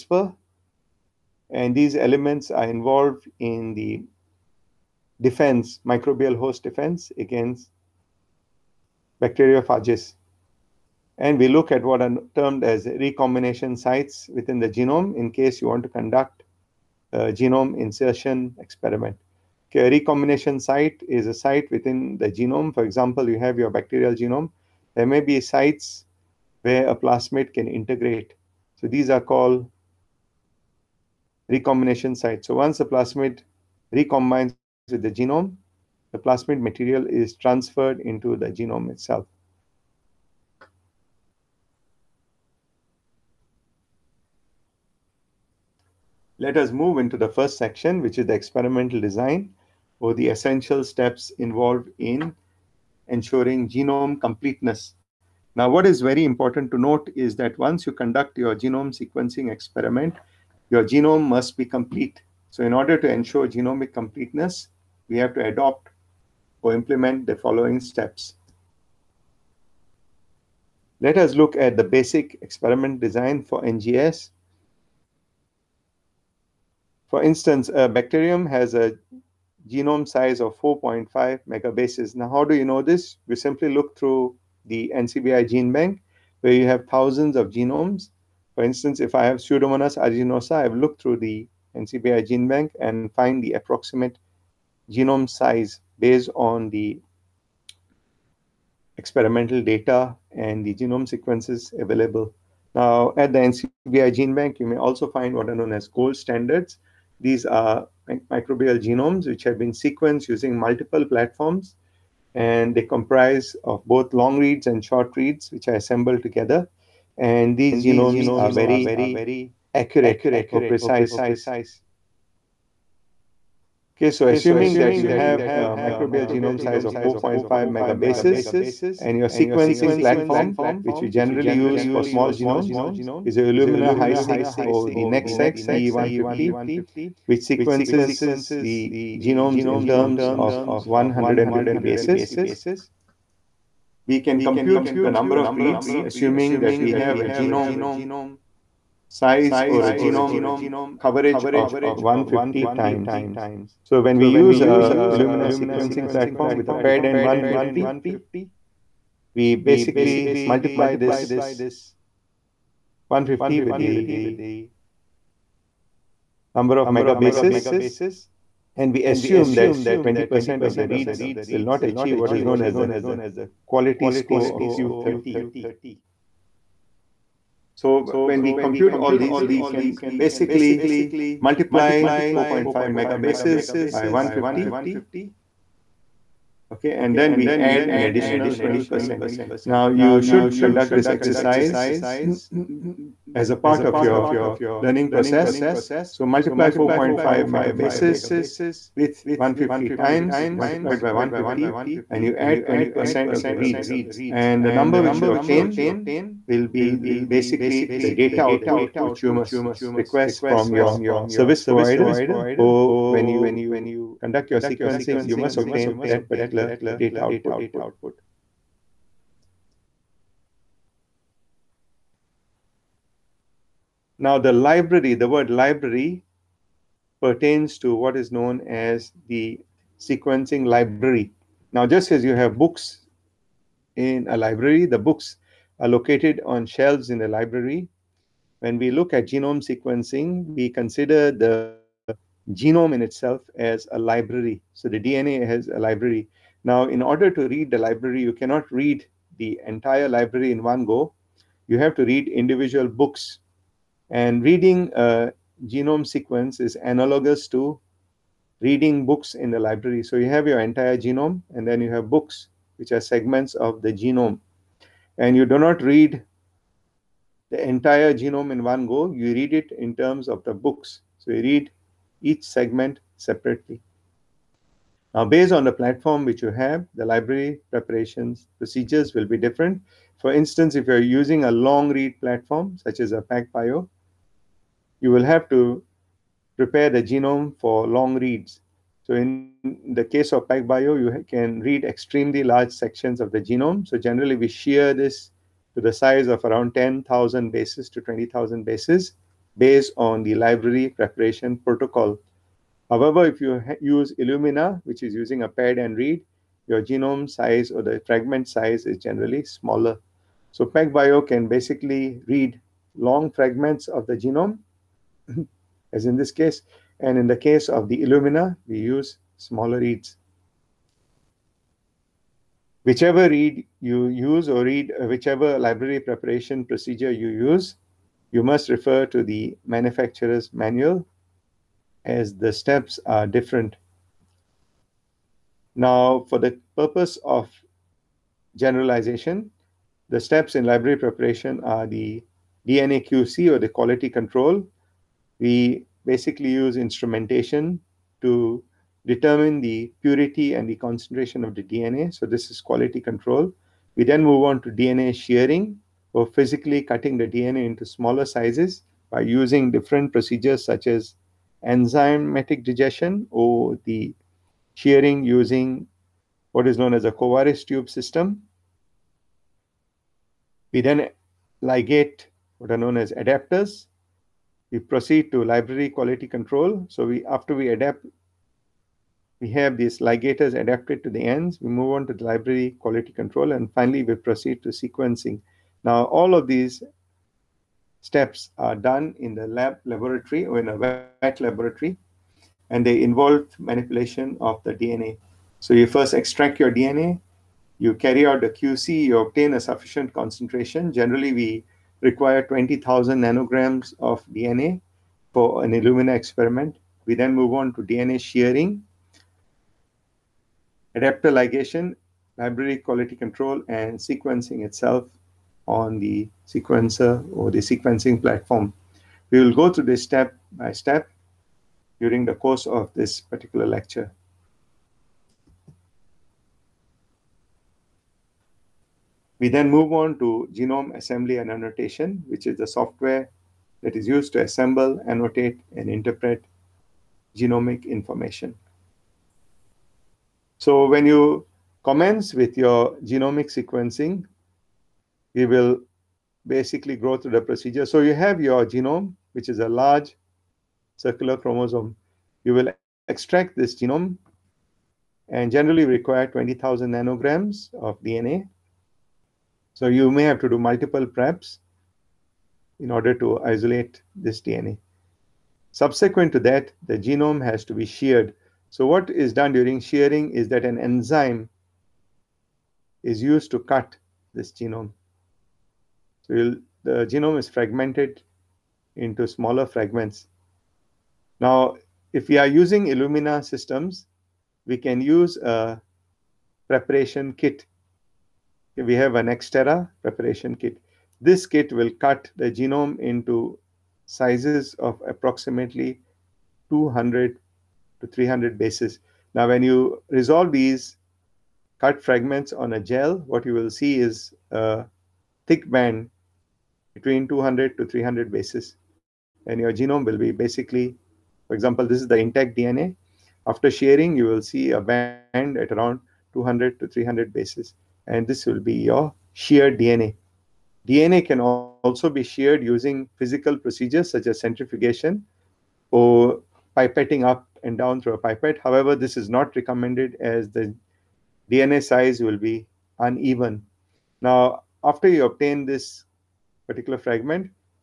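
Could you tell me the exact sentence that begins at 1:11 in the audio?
Let us look at the basic experiment design for NGS.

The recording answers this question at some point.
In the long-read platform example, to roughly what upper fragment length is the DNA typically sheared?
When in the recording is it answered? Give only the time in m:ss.
4:58.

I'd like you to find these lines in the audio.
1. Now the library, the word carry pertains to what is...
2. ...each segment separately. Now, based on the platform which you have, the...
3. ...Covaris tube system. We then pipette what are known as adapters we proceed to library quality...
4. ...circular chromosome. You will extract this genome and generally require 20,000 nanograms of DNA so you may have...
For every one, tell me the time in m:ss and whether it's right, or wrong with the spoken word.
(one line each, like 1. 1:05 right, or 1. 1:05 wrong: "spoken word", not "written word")
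1. 3:44 wrong: "library", not "carry"
2. 4:32 right
3. 6:07 wrong: "ligate", not "pipette"
4. 7:30 right.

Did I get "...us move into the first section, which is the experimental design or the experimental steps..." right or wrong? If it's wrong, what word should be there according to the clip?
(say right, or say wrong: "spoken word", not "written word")
wrong: "essential", not "experimental".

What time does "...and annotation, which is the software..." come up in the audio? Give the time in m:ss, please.
7:11.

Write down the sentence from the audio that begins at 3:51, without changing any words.
Now, just as you have books in a library, the books are located on shelves in the library.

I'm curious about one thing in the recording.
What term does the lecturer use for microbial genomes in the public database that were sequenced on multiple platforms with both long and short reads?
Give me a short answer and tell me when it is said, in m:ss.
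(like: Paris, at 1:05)
gold standards, at 1:45.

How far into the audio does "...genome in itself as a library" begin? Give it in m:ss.
4:02.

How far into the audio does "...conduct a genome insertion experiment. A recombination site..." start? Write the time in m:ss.
0:15.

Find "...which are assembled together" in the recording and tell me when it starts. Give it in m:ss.
1:55.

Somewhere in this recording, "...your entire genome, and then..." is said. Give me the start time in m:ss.
4:20.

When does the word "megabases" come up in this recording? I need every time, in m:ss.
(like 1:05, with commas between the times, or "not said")
1:21, 2:07, 2:46, 3:03, 3:17.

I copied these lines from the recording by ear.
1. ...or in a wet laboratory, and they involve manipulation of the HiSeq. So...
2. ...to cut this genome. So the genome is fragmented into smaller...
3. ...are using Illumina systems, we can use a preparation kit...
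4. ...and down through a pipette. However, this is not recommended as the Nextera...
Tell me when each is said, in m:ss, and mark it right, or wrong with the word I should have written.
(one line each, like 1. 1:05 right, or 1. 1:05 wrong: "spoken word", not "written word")
1. 6:30 wrong: "DNA", not "HiSeq"
2. 7:53 right
3. 8:02 right
4. 8:47 wrong: "DNA", not "Nextera".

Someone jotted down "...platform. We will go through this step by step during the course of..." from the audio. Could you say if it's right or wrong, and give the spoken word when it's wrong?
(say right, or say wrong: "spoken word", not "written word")
right.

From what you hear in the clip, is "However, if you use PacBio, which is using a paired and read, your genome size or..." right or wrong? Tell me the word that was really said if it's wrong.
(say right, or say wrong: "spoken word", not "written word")
wrong: "Illumina", not "PacBio".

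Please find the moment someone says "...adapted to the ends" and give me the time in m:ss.
6:20.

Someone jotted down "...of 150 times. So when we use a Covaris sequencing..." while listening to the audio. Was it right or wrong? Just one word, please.
wrong.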